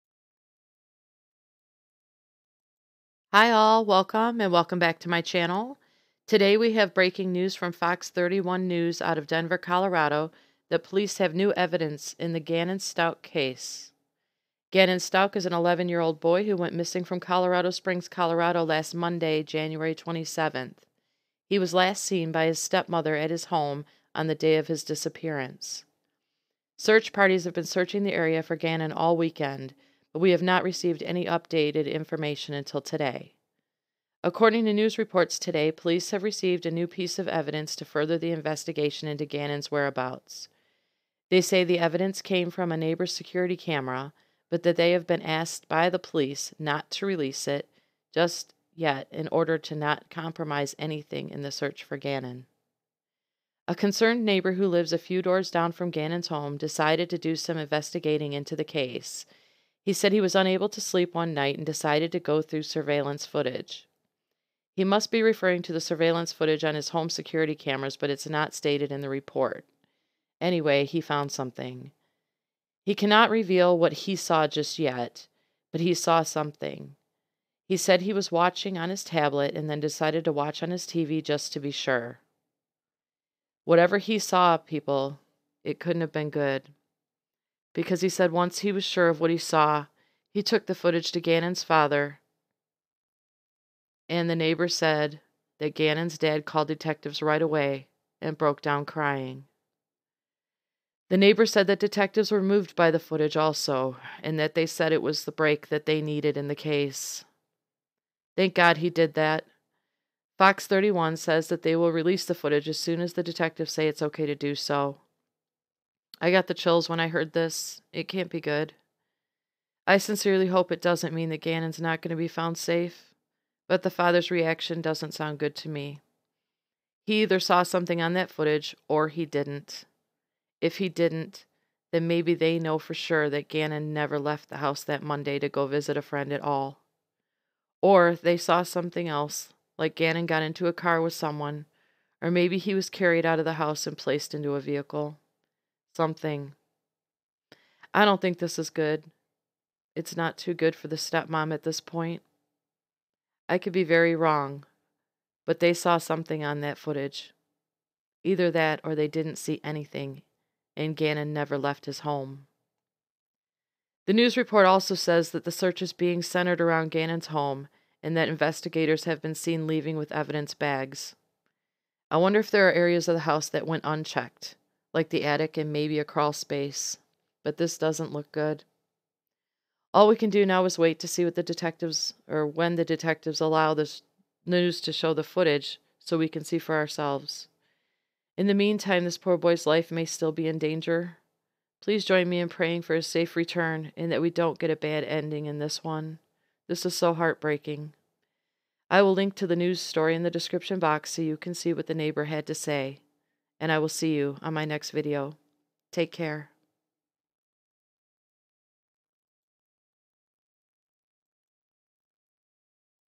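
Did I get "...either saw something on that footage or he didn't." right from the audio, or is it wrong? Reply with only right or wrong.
right.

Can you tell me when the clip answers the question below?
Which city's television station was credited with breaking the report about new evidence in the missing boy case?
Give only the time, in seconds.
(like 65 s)
9 s.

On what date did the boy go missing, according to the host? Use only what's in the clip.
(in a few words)
January 27th.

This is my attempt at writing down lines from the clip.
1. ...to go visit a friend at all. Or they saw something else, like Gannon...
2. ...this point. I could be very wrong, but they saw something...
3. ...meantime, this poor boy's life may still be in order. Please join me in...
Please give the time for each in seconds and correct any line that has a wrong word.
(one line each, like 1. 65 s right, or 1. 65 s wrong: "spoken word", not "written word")
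1. 135 s right
2. 151 s right
3. 188 s wrong: "danger", not "order".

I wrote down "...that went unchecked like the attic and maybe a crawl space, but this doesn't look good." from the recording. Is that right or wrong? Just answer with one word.
right.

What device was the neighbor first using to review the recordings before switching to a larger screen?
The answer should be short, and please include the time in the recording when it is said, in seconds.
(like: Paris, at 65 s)
tablet, at 79 s.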